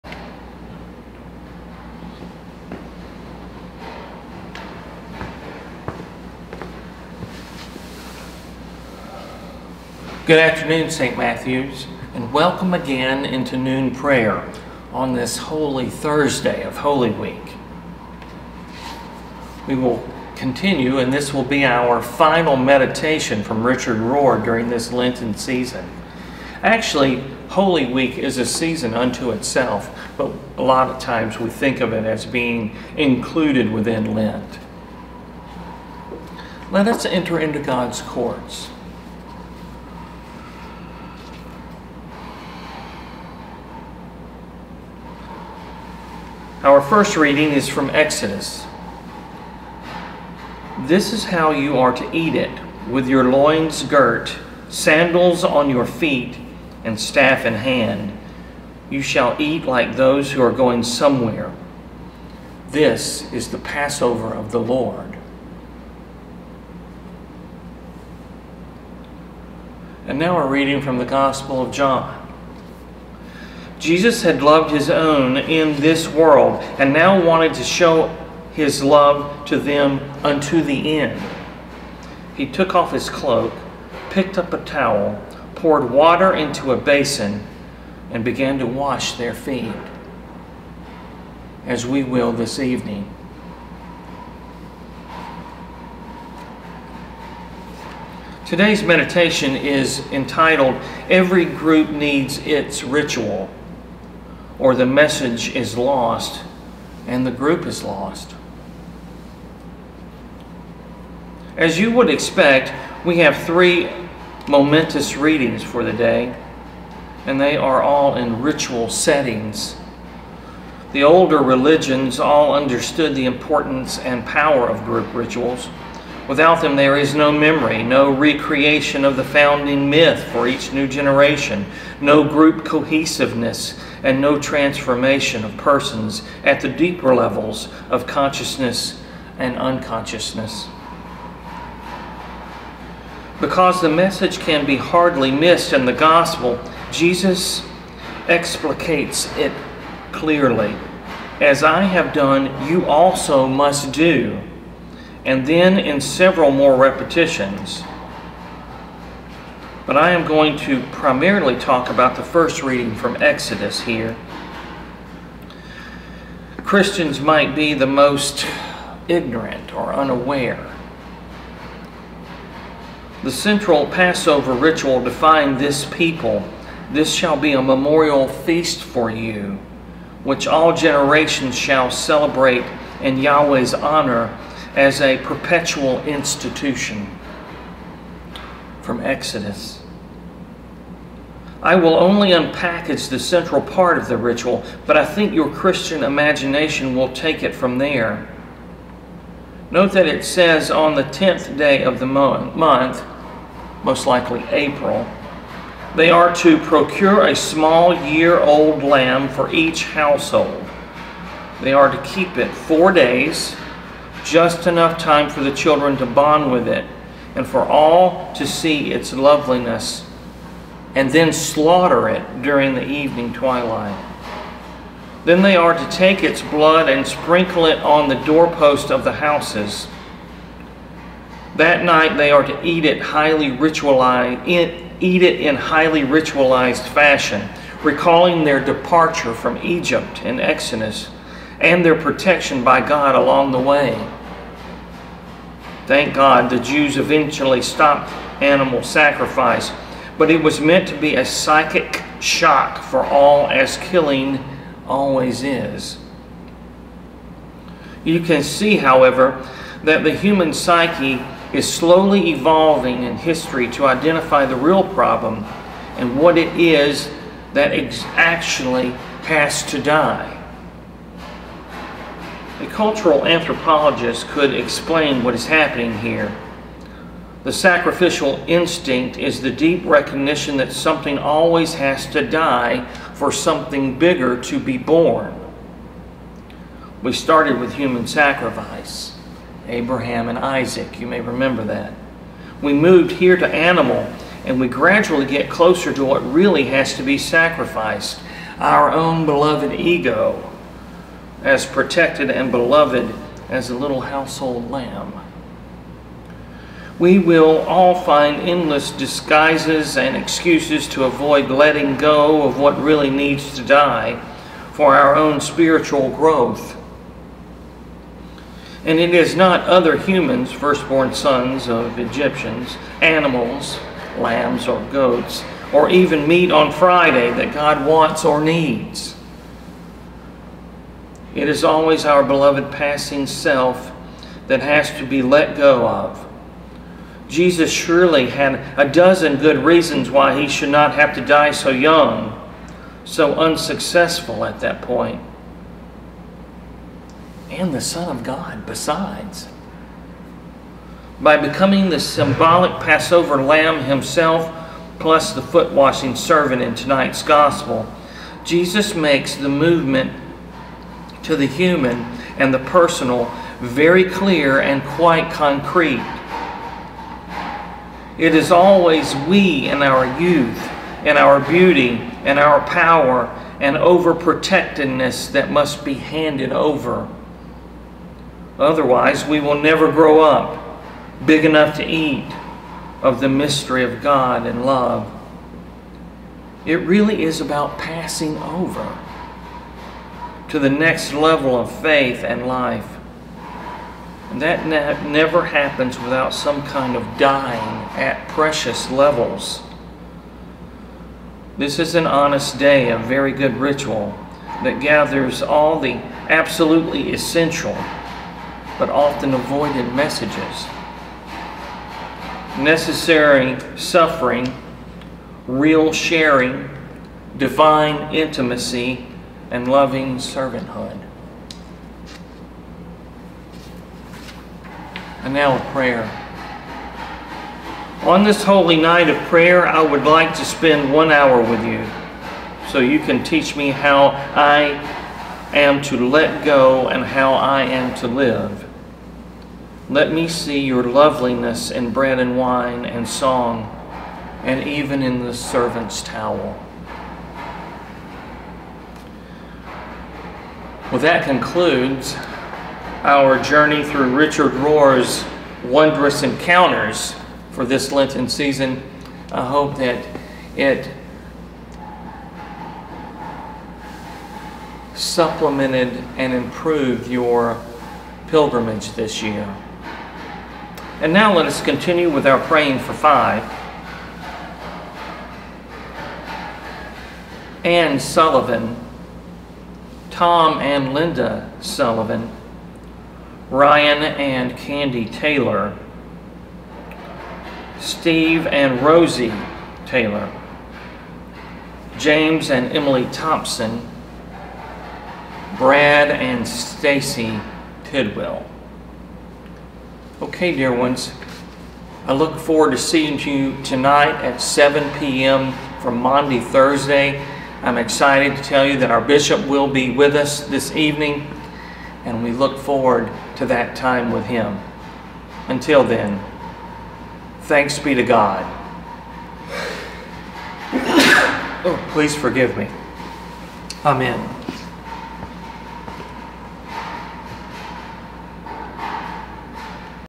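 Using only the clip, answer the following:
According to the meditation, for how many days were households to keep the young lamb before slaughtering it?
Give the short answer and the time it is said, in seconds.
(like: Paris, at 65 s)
4, at 212 s.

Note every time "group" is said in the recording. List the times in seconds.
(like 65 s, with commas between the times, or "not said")
101 s, 107 s, 124 s, 132 s.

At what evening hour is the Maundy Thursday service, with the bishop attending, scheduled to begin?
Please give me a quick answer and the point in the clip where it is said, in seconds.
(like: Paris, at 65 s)
7 p.m., at 504 s.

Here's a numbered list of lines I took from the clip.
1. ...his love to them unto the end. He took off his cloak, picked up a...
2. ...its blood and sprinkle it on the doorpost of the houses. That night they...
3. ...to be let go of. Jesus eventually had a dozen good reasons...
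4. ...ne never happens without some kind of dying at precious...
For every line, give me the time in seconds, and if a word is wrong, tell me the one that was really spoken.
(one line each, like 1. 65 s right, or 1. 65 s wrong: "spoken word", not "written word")
1. 78 s right
2. 226 s right
3. 334 s wrong: "surely", not "eventually"
4. 394 s right.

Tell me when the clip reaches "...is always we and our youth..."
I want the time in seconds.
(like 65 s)
368 s.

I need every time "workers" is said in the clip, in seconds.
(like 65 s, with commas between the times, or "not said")
not said.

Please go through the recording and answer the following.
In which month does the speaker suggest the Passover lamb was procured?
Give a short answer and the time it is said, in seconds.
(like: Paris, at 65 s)
April, at 204 s.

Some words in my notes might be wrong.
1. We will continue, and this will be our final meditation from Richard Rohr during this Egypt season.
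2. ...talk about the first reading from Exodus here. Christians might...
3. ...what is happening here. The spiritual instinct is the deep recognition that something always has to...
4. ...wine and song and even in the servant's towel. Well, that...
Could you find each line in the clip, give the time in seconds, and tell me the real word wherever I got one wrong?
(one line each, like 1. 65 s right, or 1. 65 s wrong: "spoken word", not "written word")
1. 19 s wrong: "Lenten", not "Egypt"
2. 161 s right
3. 275 s wrong: "sacrificial", not "spiritual"
4. 442 s right.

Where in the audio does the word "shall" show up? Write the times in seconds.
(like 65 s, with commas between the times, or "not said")
59 s, 177 s, 181 s.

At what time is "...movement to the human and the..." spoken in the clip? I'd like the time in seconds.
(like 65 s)
359 s.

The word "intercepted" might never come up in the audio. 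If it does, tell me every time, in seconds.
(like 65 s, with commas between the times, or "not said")
not said.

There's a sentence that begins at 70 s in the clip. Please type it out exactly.
And now we're reading from the Gospel of John.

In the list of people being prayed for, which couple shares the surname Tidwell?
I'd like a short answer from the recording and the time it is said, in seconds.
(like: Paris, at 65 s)
Brad and Stacy, at 495 s.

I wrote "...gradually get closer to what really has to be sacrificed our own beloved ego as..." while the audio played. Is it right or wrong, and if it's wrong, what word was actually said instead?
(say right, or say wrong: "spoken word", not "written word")
right.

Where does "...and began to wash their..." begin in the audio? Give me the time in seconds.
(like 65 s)
88 s.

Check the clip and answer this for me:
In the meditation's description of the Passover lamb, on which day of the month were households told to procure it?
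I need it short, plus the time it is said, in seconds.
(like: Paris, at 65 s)
10th, at 201 s.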